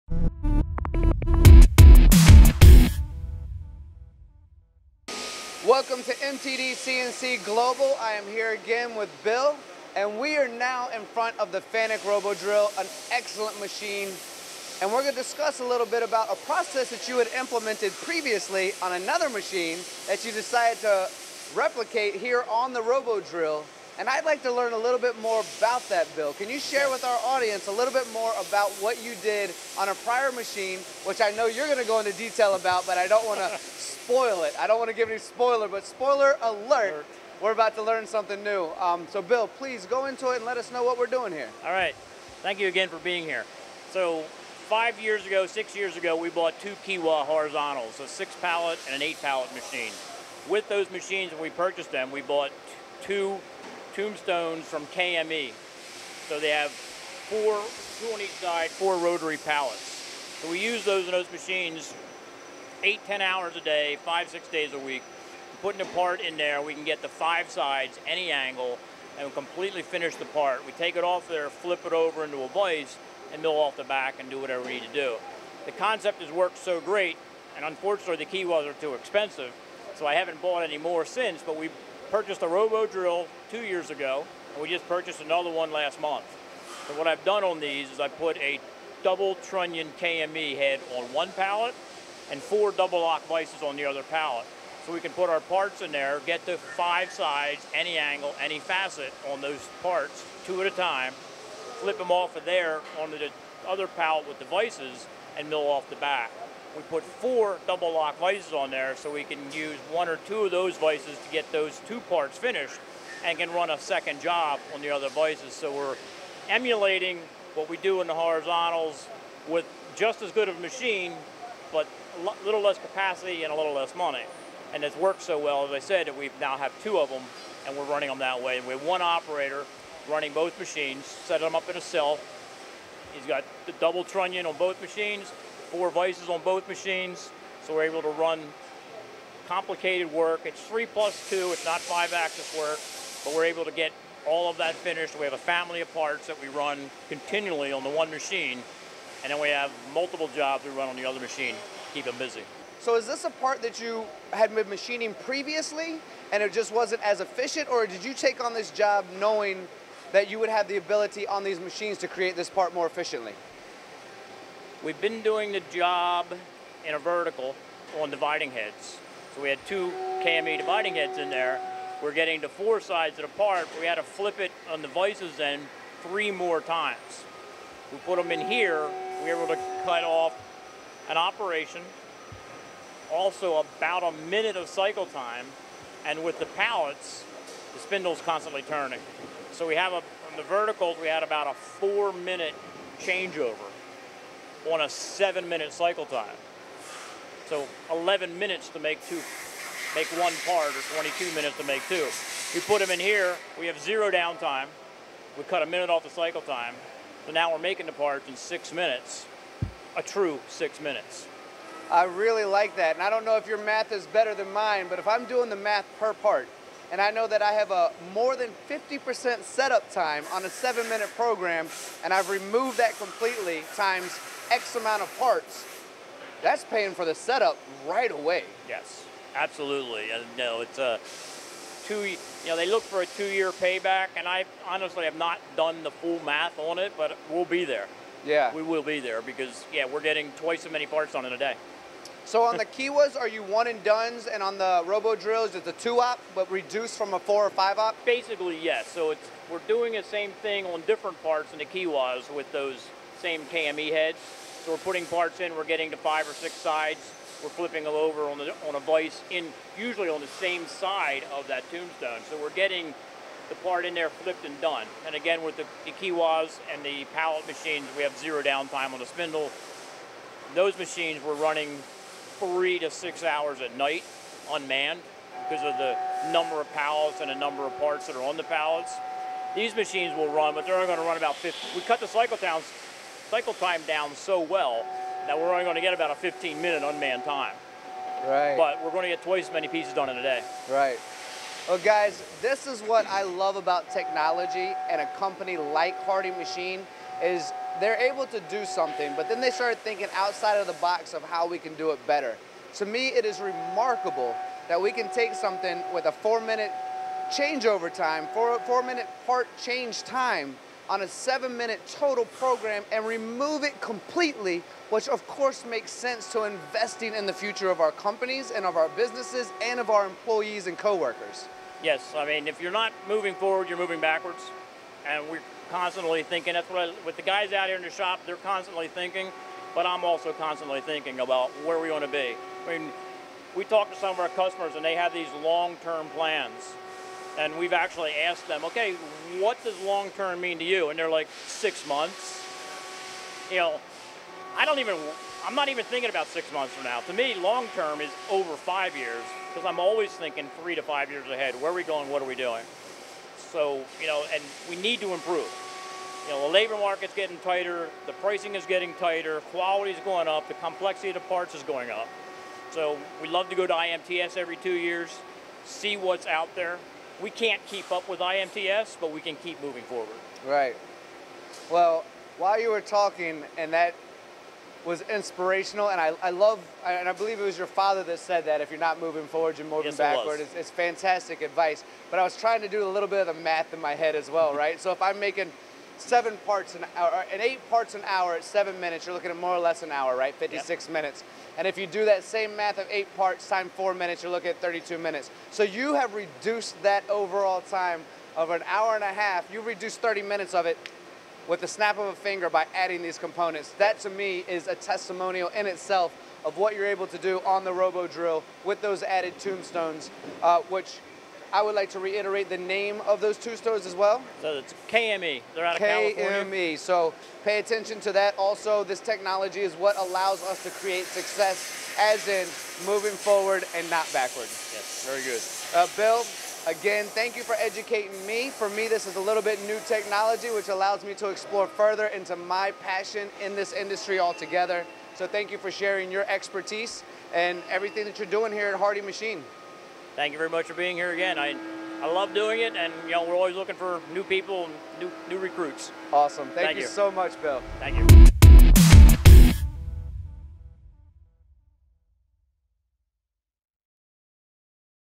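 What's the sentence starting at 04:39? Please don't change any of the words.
These machines will run, but they're only going to run about 50.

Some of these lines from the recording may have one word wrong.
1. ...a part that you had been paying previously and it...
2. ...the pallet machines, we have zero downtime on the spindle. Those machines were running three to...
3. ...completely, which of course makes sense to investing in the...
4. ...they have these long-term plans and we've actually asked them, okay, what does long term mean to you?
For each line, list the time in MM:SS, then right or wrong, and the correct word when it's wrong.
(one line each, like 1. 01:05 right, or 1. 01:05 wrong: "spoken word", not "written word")
1. 02:33 wrong: "machining", not "paying"
2. 04:26 right
3. 05:13 right
4. 05:34 right.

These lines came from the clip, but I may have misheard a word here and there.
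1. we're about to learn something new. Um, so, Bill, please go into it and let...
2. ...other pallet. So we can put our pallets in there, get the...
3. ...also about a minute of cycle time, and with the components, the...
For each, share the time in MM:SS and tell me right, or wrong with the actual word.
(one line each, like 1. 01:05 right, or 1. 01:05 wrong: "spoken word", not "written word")
1. 00:37 right
2. 01:33 wrong: "parts", not "pallets"
3. 03:03 wrong: "pallets", not "components".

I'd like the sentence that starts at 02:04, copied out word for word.
And it's worked so well, as I said, that we now have two of them and we're running them that way.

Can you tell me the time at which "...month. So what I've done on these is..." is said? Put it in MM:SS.
01:25.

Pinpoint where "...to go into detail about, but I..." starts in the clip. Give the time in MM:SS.
00:31.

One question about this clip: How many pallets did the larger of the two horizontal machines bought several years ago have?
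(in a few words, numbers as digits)
8.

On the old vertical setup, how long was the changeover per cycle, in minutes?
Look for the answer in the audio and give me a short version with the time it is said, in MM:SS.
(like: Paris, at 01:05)
4 minutes, at 03:11.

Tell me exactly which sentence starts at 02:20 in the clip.
It's three plus two, it's not five axis work but we're able to get all of that finished.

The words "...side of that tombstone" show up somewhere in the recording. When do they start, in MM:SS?
04:20.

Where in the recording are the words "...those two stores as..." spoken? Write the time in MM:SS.
06:53.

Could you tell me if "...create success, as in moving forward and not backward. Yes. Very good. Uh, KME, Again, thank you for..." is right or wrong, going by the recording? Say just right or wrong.
wrong.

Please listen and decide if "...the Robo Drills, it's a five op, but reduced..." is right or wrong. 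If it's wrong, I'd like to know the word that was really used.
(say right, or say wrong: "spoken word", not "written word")
wrong: "two", not "five".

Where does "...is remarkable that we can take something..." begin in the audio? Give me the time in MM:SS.
05:03.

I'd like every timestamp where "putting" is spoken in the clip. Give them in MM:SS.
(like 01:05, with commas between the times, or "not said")
01:05, 04:14.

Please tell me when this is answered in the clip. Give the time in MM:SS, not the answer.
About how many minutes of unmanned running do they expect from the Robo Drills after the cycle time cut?
04:46.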